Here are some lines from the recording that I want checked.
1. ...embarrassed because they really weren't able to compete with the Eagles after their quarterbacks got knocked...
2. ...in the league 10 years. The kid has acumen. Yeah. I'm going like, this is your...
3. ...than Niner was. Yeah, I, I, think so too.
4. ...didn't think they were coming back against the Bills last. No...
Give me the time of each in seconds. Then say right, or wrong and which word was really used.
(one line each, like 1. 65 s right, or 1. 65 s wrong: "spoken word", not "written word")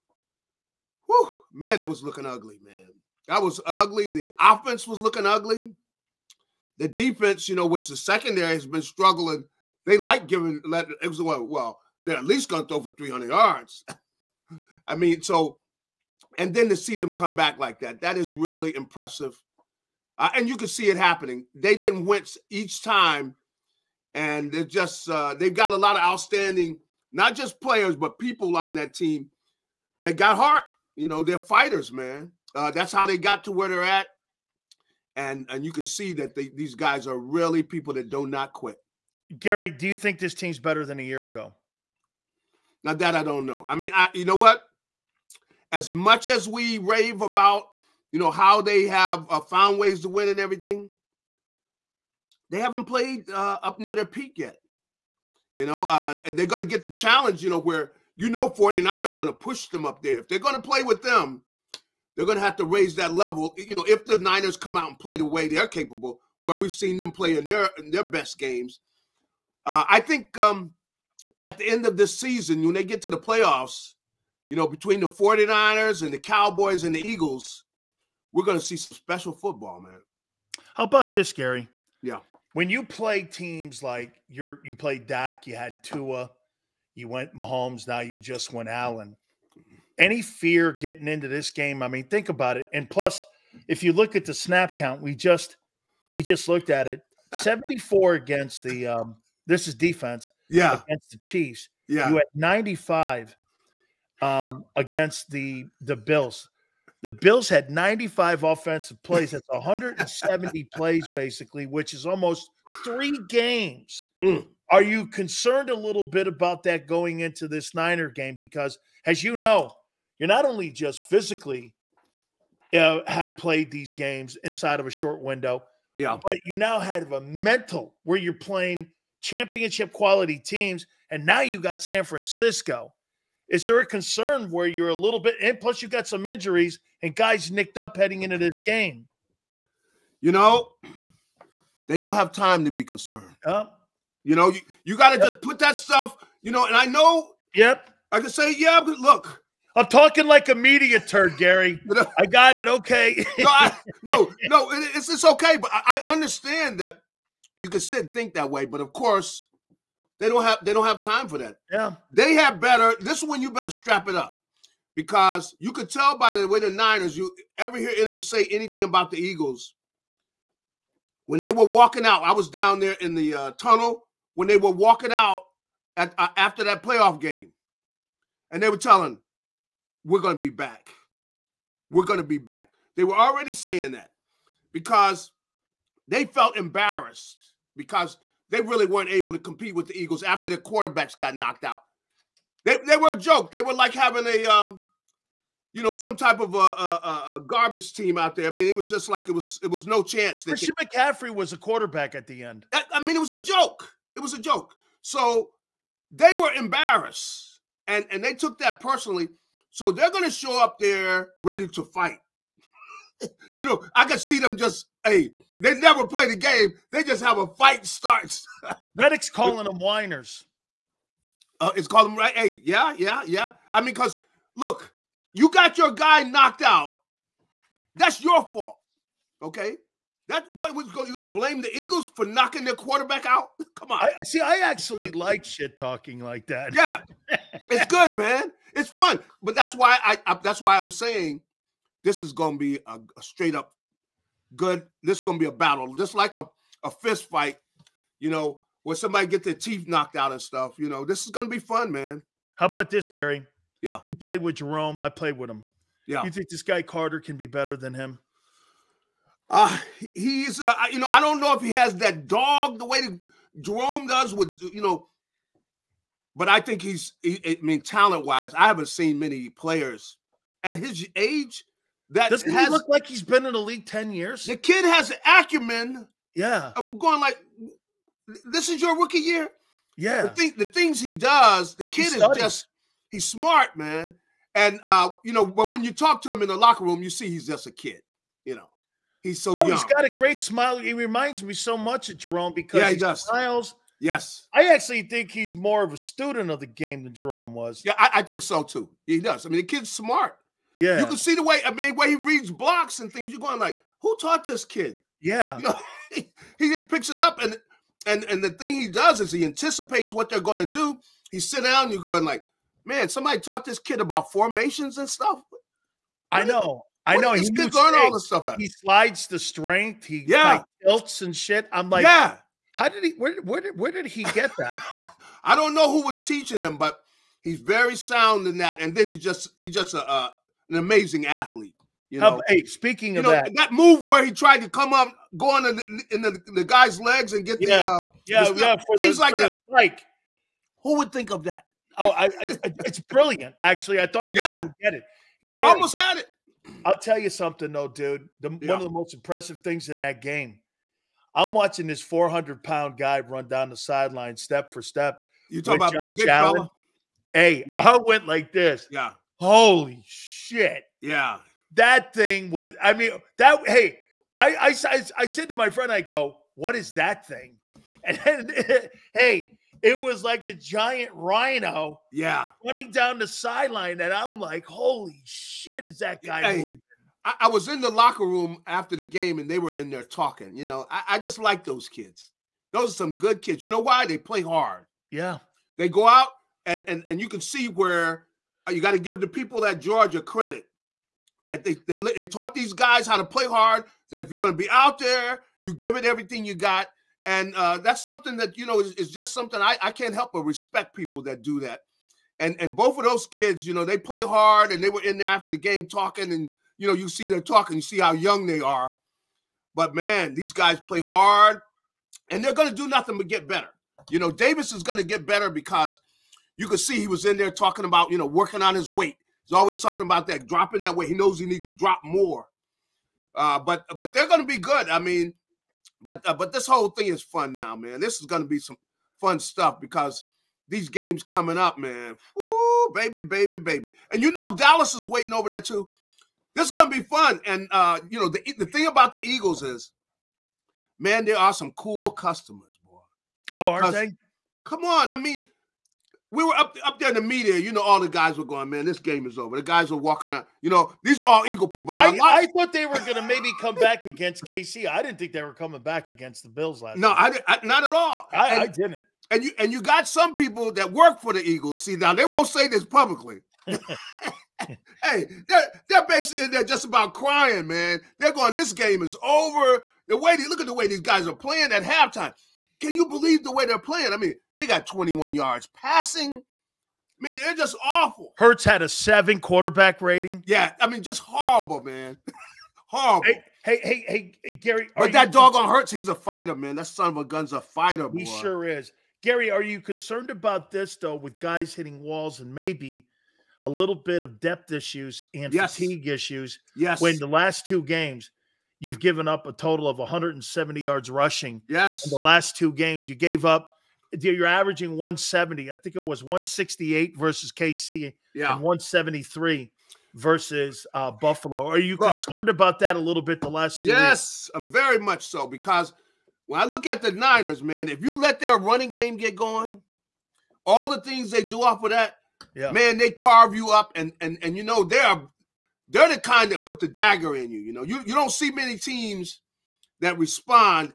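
1. 186 s right
2. 273 s right
3. 297 s wrong: "Jerome", not "Niner"
4. 455 s right.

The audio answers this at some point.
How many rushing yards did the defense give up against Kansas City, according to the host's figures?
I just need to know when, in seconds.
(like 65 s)
506 s.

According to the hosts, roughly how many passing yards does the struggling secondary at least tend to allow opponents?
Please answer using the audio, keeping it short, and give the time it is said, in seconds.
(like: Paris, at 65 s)
300 yards, at 12 s.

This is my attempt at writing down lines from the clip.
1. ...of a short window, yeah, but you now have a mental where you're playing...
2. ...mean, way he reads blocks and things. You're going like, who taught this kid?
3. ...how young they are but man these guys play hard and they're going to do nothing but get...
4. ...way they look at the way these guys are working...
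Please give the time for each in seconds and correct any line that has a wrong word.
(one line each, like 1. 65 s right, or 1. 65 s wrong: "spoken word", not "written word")
1. 124 s right
2. 301 s right
3. 407 s right
4. 470 s wrong: "playing", not "working".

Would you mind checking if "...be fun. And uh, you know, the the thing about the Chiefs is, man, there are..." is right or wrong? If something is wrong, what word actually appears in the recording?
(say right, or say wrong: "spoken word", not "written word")
wrong: "Eagles", not "Chiefs".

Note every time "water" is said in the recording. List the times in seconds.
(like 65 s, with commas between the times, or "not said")
not said.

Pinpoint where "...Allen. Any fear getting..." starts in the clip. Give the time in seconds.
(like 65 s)
88 s.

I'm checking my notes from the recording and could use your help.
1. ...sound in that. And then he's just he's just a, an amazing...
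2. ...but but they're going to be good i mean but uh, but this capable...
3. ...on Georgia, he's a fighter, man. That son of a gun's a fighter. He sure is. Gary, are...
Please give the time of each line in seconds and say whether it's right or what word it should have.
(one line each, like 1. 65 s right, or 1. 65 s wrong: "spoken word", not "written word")
1. 327 s right
2. 423 s wrong: "whole", not "capable"
3. 485 s wrong: "Hurts", not "Georgia".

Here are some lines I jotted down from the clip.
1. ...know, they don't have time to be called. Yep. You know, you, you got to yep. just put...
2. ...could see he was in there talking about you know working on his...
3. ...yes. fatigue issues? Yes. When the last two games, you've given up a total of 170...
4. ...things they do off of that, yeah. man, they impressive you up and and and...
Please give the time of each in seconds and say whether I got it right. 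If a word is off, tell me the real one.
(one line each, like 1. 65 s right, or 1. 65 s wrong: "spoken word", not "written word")
1. 140 s wrong: "concerned", not "called"
2. 416 s right
3. 495 s right
4. 521 s wrong: "carve", not "impressive".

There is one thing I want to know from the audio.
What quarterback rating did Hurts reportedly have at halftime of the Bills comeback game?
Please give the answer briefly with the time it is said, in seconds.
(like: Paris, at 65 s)
7, at 478 s.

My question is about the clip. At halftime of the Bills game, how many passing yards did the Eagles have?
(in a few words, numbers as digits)
21.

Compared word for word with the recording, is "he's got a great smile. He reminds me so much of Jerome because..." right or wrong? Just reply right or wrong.
right.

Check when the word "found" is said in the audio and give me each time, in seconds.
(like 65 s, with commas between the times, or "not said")
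49 s.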